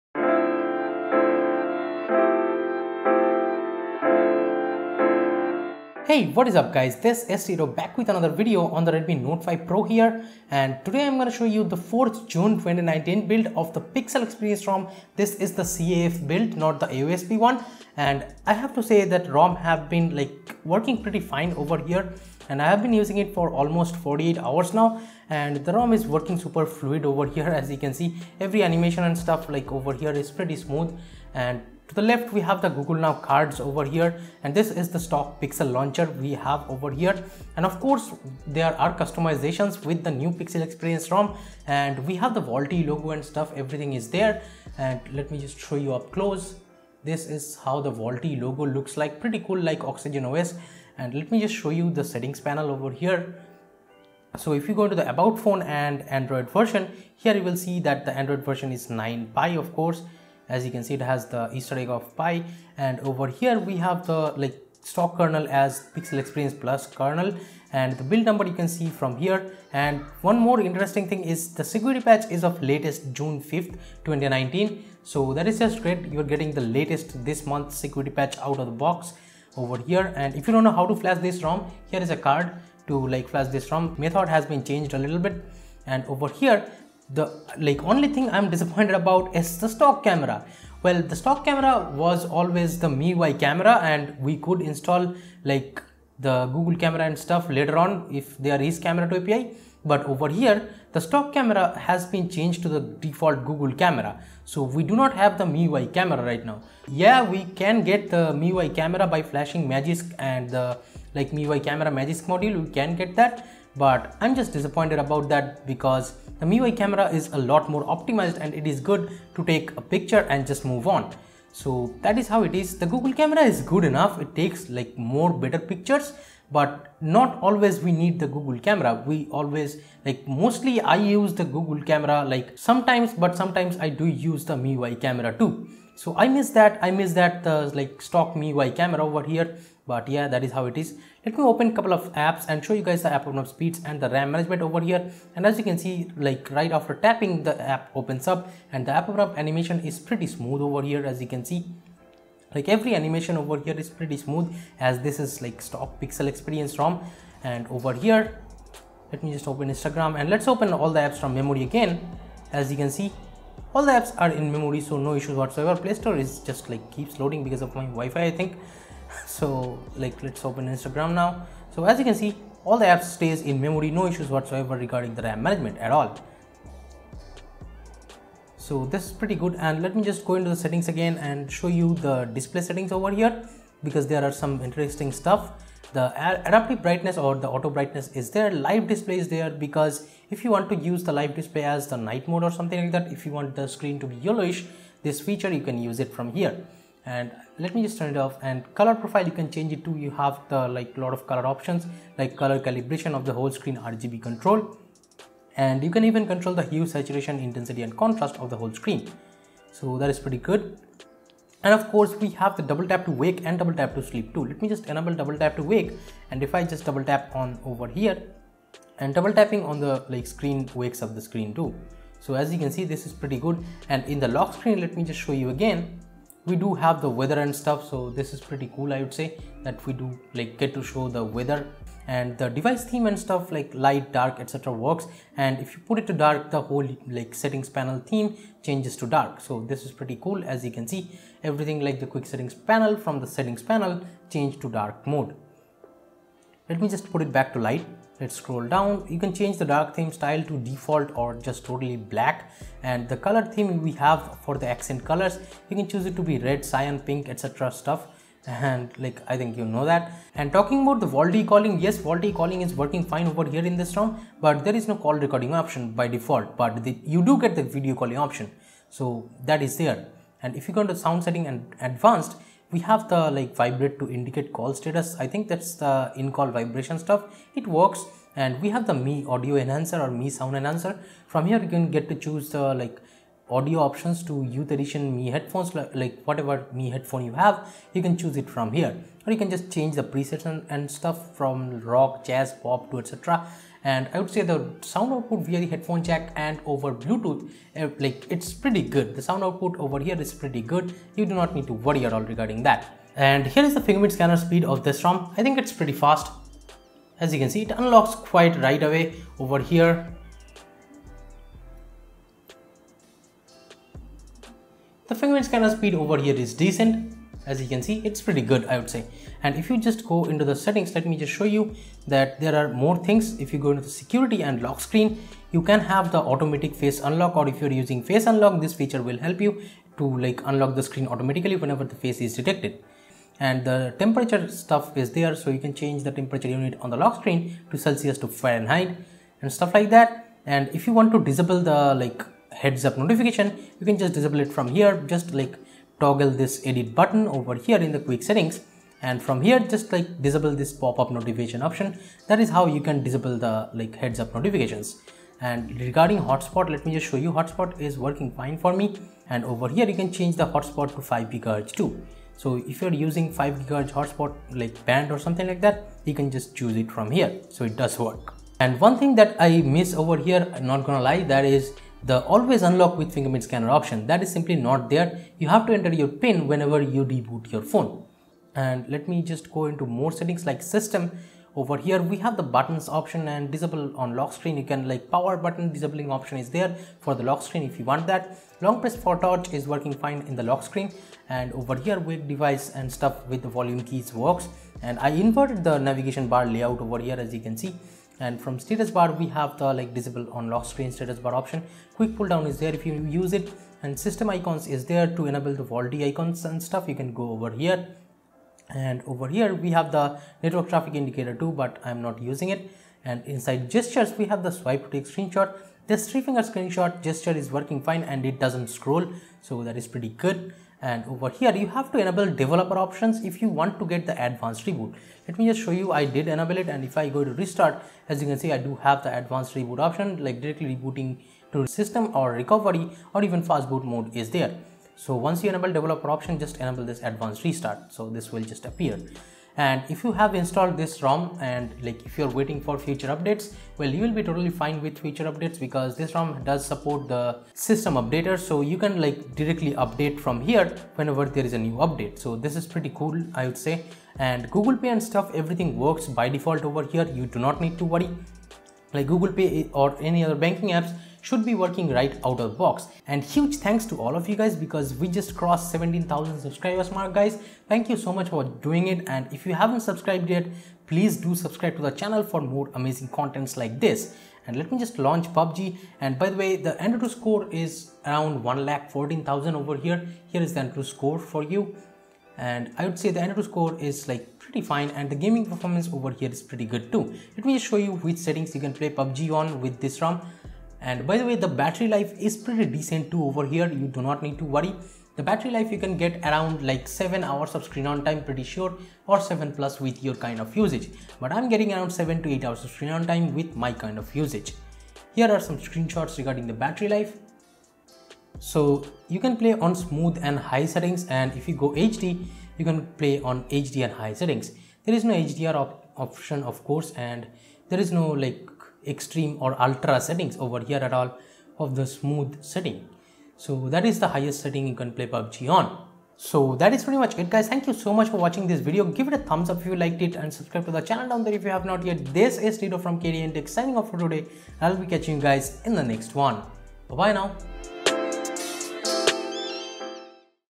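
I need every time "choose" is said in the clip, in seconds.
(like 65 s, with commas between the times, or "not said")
255 s, 282 s, 288 s, 366 s.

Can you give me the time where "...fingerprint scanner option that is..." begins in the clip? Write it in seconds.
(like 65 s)
373 s.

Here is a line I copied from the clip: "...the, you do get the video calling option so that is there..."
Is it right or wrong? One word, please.
right.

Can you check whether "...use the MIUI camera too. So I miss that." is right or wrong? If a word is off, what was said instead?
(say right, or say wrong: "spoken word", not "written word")
right.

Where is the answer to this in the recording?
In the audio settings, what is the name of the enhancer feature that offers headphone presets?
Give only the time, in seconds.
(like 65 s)
280 s.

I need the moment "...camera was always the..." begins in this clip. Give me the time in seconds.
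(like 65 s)
91 s.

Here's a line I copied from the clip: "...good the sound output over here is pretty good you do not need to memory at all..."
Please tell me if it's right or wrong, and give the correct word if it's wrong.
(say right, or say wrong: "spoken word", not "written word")
wrong: "worry", not "memory".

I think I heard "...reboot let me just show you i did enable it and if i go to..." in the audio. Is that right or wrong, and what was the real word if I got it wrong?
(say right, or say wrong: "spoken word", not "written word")
right.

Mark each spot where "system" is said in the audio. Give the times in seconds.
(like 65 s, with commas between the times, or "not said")
380 s, 404 s, 431 s, 447 s.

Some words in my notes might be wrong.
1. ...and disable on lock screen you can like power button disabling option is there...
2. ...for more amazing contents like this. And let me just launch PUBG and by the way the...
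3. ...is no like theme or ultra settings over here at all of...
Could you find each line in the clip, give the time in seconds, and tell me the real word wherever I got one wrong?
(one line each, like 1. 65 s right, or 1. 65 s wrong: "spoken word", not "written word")
1. 383 s right
2. 472 s right
3. 517 s wrong: "extreme", not "theme".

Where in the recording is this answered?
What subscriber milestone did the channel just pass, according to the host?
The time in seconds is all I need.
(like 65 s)
465 s.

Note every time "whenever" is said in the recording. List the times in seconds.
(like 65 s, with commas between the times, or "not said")
331 s, 376 s, 450 s.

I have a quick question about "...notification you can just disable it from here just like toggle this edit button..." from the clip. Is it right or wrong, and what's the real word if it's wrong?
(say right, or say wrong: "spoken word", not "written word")
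right.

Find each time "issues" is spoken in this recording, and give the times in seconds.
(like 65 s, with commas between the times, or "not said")
165 s, 174 s.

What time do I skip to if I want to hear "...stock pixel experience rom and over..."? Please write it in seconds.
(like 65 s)
155 s.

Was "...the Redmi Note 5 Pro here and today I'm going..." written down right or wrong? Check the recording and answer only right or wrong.
right.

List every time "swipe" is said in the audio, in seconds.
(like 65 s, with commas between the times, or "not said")
414 s.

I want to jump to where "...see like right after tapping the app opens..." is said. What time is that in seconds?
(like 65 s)
145 s.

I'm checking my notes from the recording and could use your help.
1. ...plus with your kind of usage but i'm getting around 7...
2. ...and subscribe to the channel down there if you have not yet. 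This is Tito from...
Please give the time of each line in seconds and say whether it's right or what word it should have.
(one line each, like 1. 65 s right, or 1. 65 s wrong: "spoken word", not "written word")
1. 499 s right
2. 530 s right.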